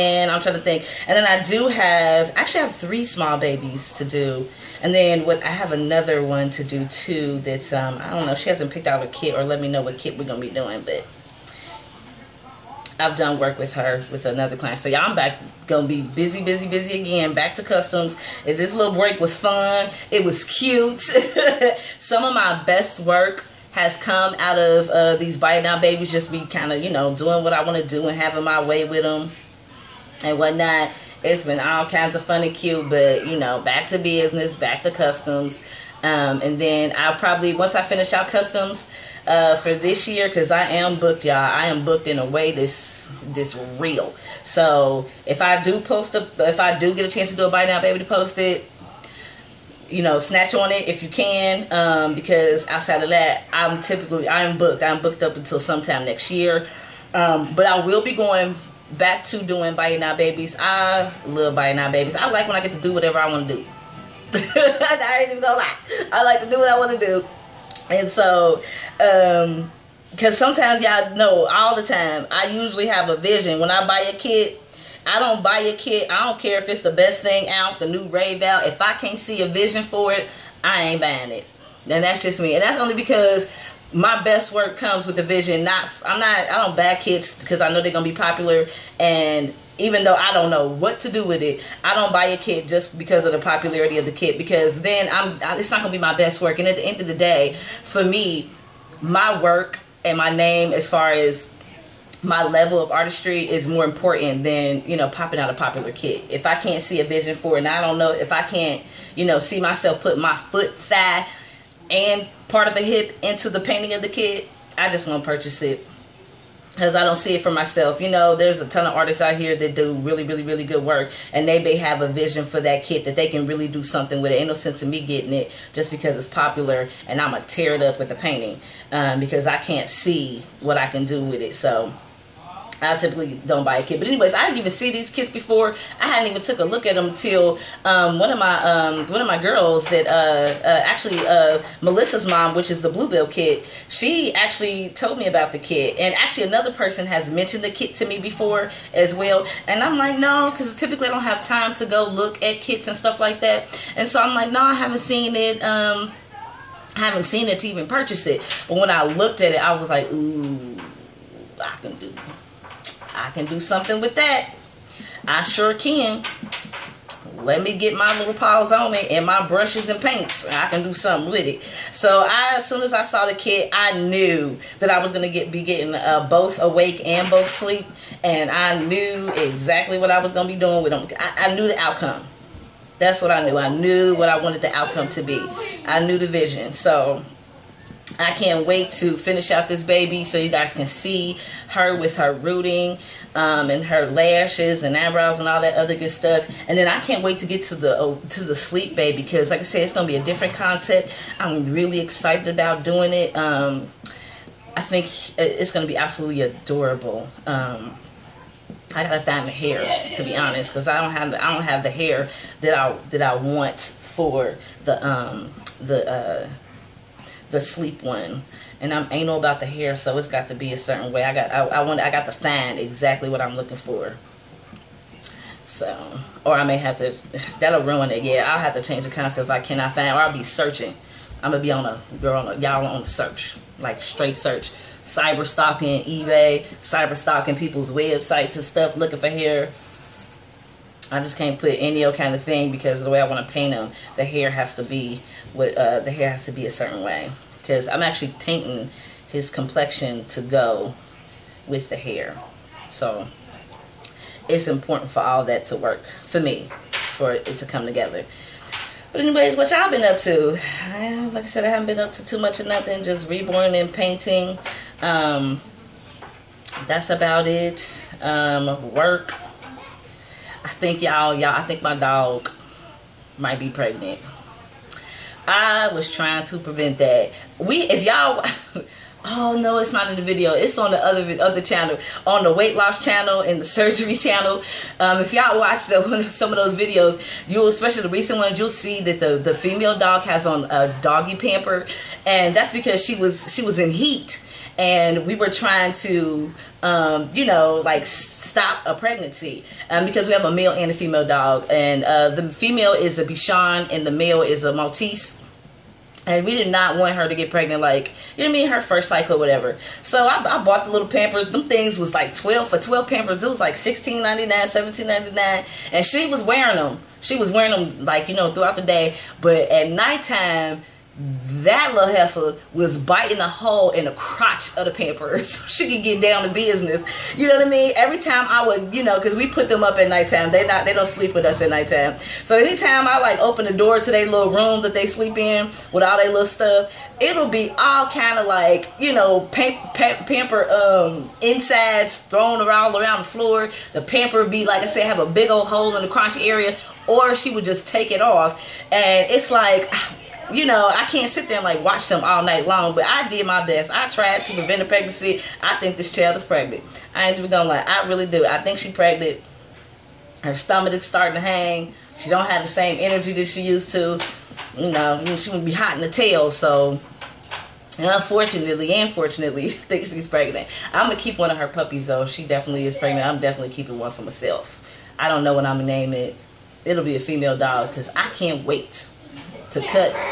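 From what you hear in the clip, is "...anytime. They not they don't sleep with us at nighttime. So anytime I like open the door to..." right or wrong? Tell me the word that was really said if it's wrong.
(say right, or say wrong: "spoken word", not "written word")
wrong: "nighttime", not "anytime".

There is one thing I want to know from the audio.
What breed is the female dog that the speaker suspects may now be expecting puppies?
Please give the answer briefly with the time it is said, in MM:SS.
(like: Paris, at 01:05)
Bichon, at 05:03.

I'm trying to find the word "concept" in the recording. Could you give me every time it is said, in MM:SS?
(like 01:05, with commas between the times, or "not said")
03:20, 03:49.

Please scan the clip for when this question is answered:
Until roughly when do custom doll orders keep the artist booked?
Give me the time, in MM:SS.
00:56.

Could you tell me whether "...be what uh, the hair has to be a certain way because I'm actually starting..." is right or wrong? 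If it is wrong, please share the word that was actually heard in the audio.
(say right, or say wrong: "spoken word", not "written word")
wrong: "painting", not "starting".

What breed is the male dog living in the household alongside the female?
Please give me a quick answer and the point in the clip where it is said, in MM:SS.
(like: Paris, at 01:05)
Maltese, at 05:04.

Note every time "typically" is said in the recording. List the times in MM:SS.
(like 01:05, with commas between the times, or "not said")
00:53, 02:12, 02:30.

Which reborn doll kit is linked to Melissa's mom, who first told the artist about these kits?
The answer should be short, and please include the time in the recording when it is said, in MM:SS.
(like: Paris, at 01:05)
Bluebell, at 02:22.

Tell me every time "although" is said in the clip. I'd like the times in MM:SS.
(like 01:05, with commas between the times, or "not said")
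not said.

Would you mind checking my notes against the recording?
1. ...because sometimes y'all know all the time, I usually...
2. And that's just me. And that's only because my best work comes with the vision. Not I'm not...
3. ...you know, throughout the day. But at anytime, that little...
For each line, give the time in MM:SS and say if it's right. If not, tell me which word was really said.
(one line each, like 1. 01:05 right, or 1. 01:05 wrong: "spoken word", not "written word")
1. 01:10 right
2. 01:21 right
3. 05:18 wrong: "nighttime", not "anytime".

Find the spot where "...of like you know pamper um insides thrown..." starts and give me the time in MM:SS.
05:38.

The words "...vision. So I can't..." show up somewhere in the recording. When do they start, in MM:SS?
03:06.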